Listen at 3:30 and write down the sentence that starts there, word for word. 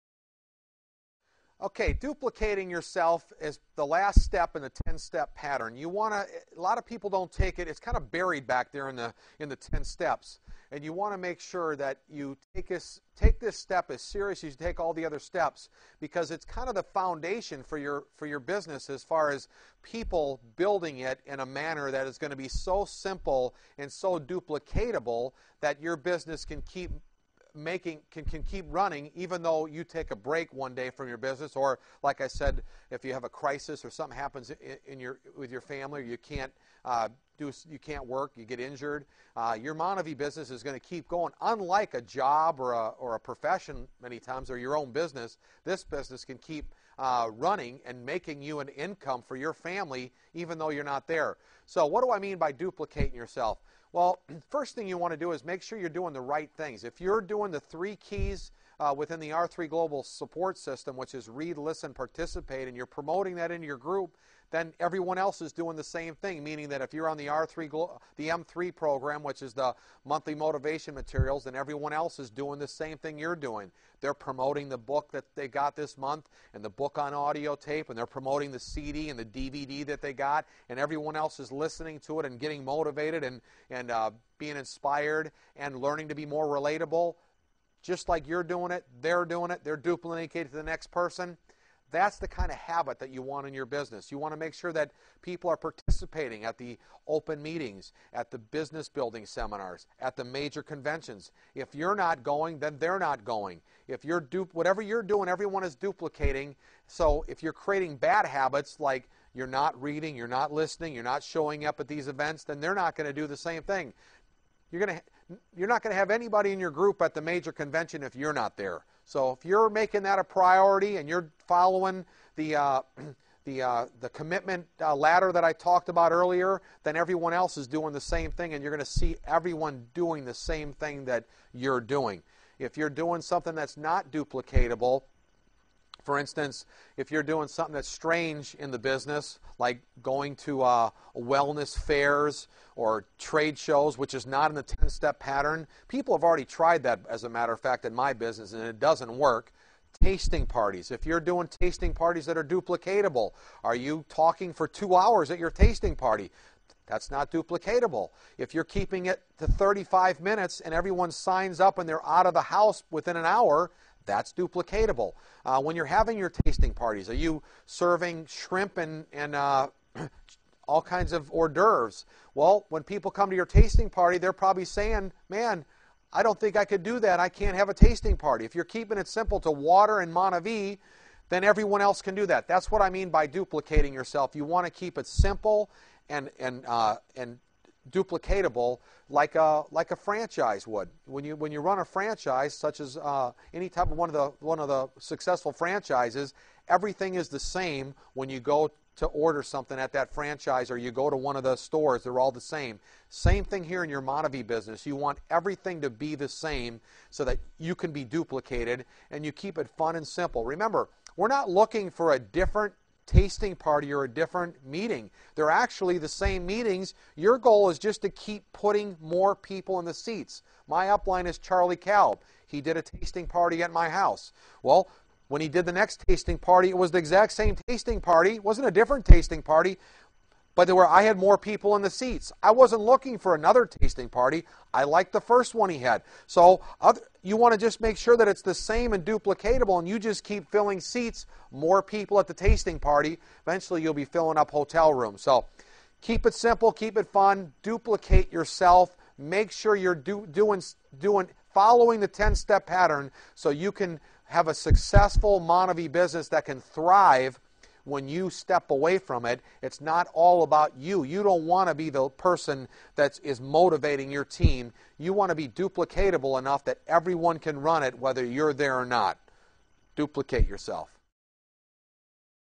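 Remember, we're not looking for a different tasting party or a different meeting.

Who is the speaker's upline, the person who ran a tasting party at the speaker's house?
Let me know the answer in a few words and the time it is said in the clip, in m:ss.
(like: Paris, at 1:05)
Charlie Calb, at 3:41.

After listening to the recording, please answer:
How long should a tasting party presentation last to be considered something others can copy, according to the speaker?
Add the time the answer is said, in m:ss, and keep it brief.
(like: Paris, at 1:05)
35 minutes, at 2:39.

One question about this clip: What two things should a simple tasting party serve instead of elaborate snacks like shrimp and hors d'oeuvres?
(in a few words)
water and Monavie.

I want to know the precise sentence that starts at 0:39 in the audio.
Uh, your Monavie business is going to keep going.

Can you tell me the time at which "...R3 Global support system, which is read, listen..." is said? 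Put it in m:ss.
0:59.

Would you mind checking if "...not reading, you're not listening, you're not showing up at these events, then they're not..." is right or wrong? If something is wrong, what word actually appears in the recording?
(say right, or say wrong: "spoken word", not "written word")
right.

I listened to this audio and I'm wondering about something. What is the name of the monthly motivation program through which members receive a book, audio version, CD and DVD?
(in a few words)
M3.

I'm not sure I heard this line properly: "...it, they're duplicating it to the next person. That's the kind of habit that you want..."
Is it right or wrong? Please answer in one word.
right.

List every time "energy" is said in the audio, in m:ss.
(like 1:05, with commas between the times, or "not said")
not said.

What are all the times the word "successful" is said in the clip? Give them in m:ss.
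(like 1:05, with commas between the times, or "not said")
3:14, 4:14.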